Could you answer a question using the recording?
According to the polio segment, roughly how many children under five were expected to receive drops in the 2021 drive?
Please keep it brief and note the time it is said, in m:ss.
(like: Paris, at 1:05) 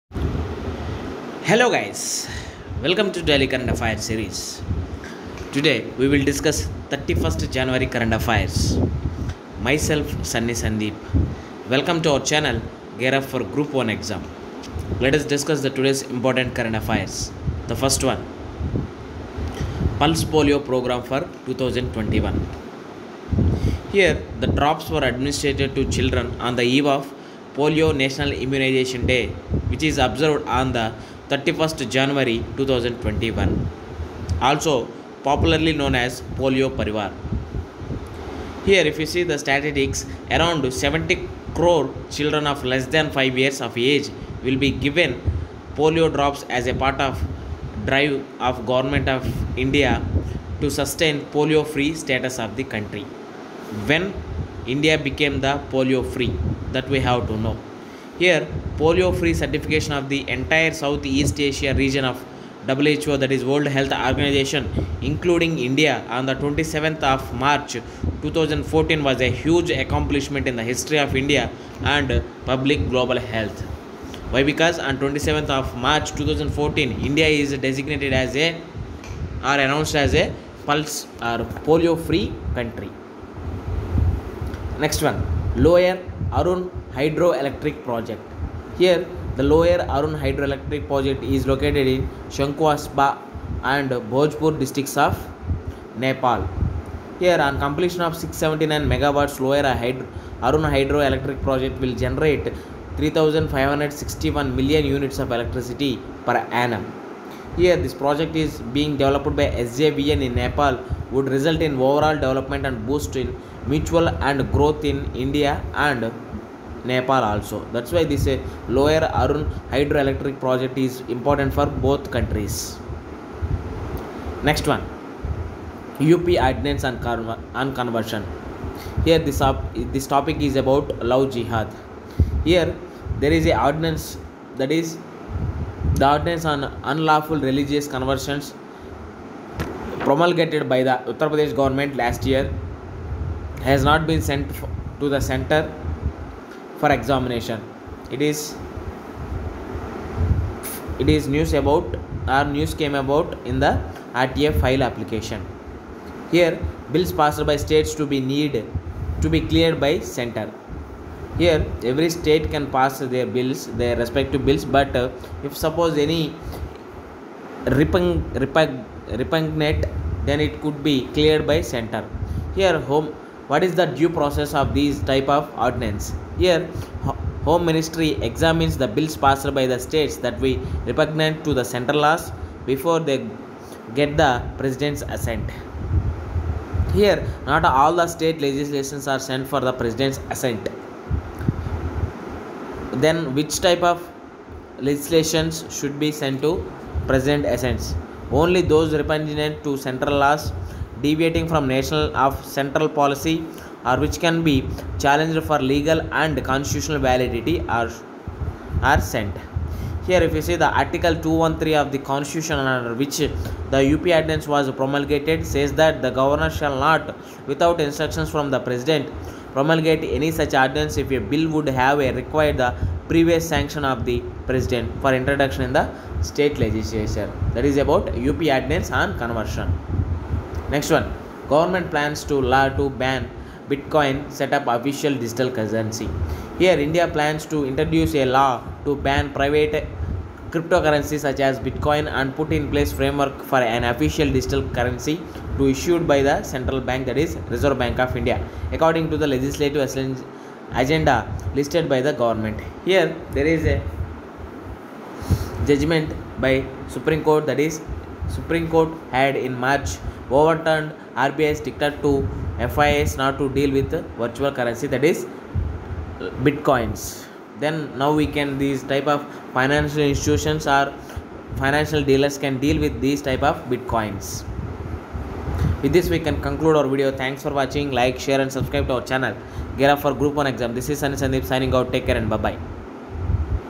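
70 crore, at 0:40.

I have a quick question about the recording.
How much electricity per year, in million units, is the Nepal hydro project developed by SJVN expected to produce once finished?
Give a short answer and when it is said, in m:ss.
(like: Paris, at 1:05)
3561 million units, at 1:42.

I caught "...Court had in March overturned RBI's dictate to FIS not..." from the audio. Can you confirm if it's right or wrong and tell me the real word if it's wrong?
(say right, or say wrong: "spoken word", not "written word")
right.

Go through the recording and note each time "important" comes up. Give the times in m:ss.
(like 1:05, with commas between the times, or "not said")
0:16, 2:01.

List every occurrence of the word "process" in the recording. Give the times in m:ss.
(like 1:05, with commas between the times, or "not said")
2:54.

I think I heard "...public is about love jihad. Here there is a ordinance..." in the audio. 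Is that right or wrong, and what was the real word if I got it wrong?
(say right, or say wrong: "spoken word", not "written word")
wrong: "topic", not "public".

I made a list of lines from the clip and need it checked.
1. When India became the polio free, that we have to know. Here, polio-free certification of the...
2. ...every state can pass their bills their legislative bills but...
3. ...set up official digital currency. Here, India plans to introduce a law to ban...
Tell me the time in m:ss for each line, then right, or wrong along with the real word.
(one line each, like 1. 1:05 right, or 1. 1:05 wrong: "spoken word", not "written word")
1. 0:53 right
2. 2:41 wrong: "respective", not "legislative"
3. 3:54 right.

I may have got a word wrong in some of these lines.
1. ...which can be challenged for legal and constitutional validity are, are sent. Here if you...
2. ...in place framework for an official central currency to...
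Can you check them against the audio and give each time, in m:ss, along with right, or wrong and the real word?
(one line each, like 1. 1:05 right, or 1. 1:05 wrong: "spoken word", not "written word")
1. 3:23 right
2. 4:02 wrong: "digital", not "central".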